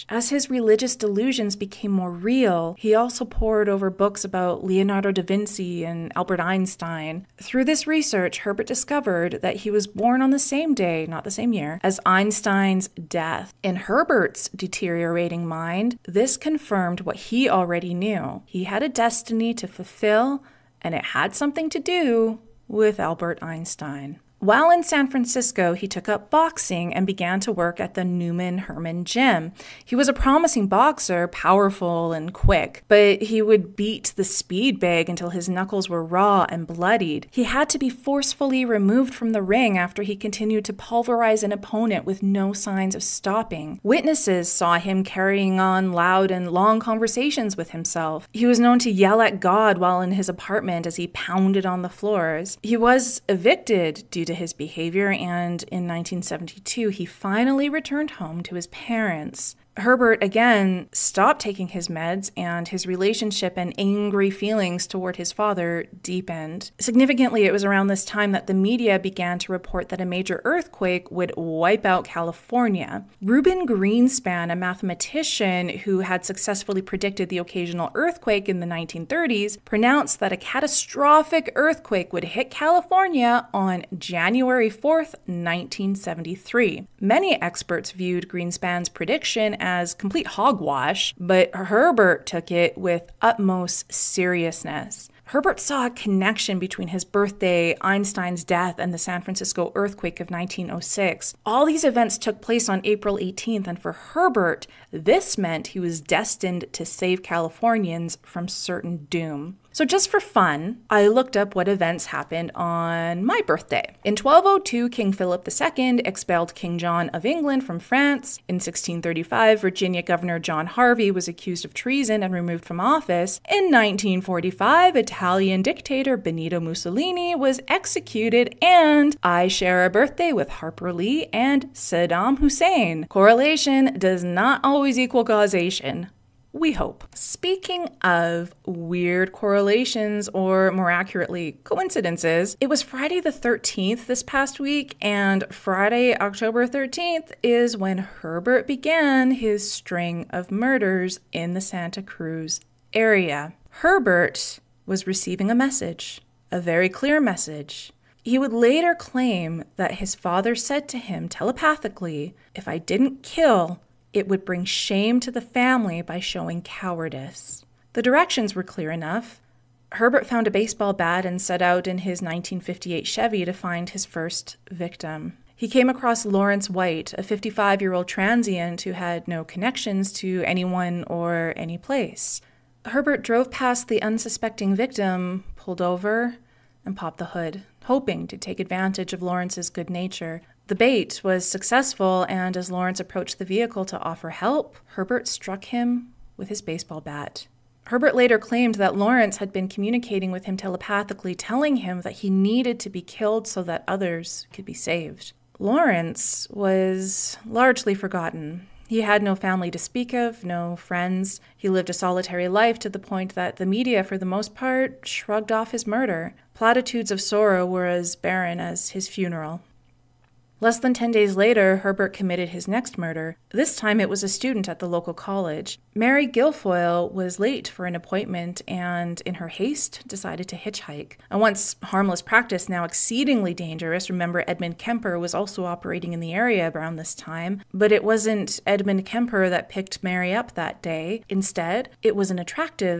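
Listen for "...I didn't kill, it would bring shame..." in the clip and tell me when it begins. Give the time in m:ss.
2:42.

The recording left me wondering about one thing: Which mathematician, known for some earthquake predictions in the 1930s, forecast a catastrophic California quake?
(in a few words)
Reuben Greenspan.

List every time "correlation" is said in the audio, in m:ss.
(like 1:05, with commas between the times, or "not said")
2:13, 2:19.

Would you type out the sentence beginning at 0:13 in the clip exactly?
In Herbert's deteriorating mind, this confirmed what he already knew.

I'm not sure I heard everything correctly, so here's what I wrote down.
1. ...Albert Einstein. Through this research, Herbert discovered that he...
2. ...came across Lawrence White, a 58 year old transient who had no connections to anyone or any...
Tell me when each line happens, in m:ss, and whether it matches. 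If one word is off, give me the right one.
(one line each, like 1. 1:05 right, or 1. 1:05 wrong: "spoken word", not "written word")
1. 0:06 right
2. 2:55 wrong: "55", not "58".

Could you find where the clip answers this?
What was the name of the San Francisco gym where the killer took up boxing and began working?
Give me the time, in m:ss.
0:28.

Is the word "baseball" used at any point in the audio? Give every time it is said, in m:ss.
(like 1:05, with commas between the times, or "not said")
2:50, 3:16.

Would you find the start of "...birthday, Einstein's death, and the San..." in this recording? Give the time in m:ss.
1:37.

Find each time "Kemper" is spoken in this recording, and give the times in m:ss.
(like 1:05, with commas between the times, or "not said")
3:54, 3:59.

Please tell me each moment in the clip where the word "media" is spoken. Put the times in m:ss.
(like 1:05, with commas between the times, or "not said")
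1:08, 3:33.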